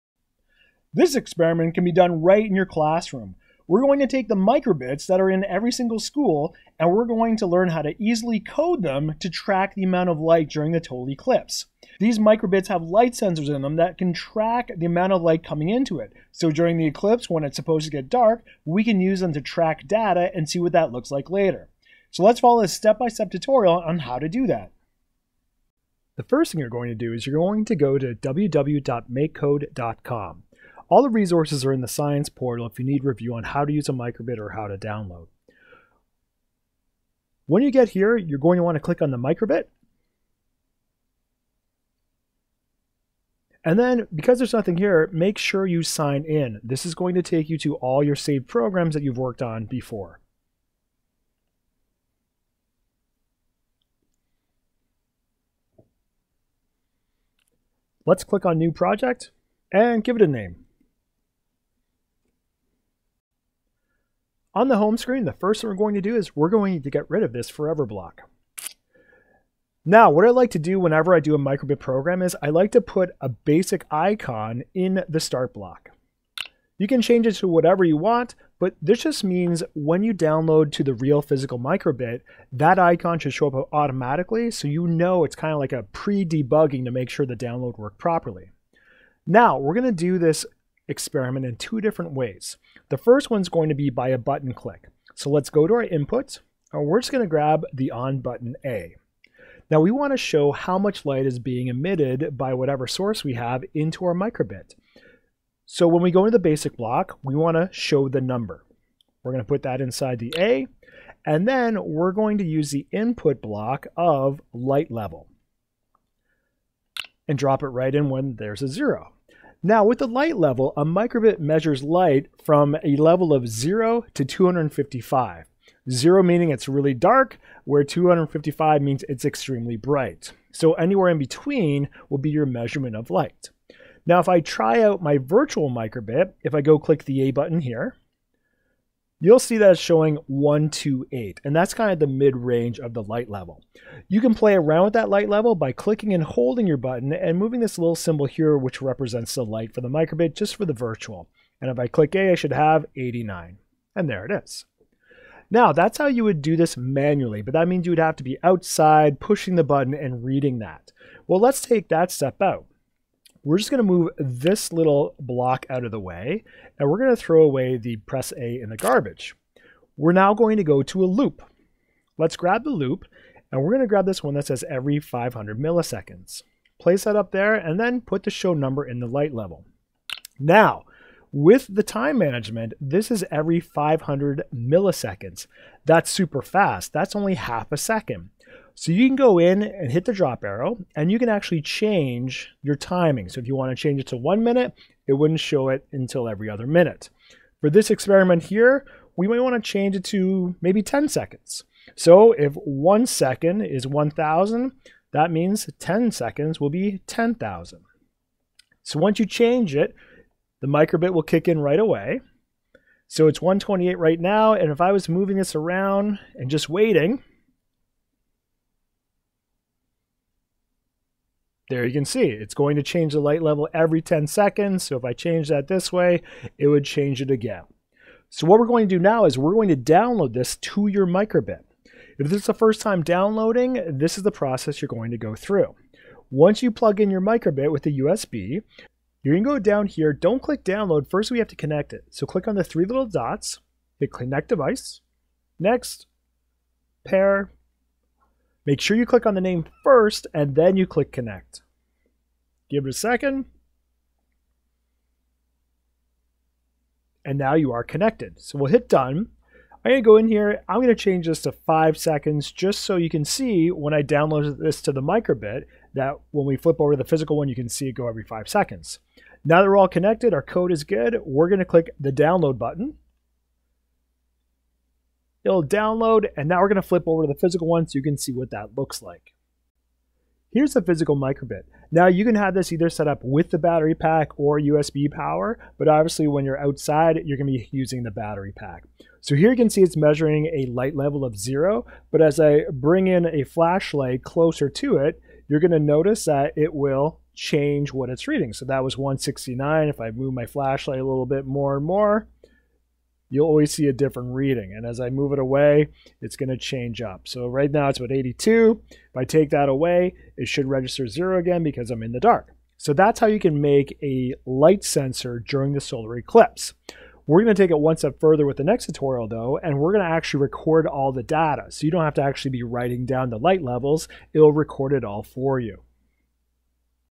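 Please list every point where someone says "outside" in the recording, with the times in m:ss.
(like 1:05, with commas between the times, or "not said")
2:38, 4:46.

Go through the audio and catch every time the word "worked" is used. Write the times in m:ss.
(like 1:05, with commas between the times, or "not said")
0:49, 1:27.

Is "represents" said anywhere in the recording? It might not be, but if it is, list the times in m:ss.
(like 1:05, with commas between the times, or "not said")
2:28.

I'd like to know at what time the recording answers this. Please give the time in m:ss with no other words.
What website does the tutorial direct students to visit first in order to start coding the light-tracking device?
0:28.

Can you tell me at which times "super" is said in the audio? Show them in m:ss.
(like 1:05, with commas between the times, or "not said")
3:06.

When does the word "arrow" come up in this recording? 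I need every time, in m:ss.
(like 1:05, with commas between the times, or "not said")
3:10.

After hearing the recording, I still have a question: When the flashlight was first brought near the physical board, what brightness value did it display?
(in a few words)
169.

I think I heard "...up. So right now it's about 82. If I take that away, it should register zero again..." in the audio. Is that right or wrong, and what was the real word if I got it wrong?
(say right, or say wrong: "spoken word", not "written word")
right.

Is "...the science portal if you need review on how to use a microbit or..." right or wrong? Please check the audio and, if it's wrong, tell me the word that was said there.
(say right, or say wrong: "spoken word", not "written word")
right.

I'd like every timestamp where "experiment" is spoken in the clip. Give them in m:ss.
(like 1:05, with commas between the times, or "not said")
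0:01, 1:30, 3:17.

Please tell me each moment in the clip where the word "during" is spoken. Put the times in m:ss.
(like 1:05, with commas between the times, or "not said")
0:10, 0:16, 5:15.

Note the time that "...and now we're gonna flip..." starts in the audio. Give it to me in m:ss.
4:36.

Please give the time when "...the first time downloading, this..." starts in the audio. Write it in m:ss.
3:52.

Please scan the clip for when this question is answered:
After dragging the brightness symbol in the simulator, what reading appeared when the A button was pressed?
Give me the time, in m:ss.
2:32.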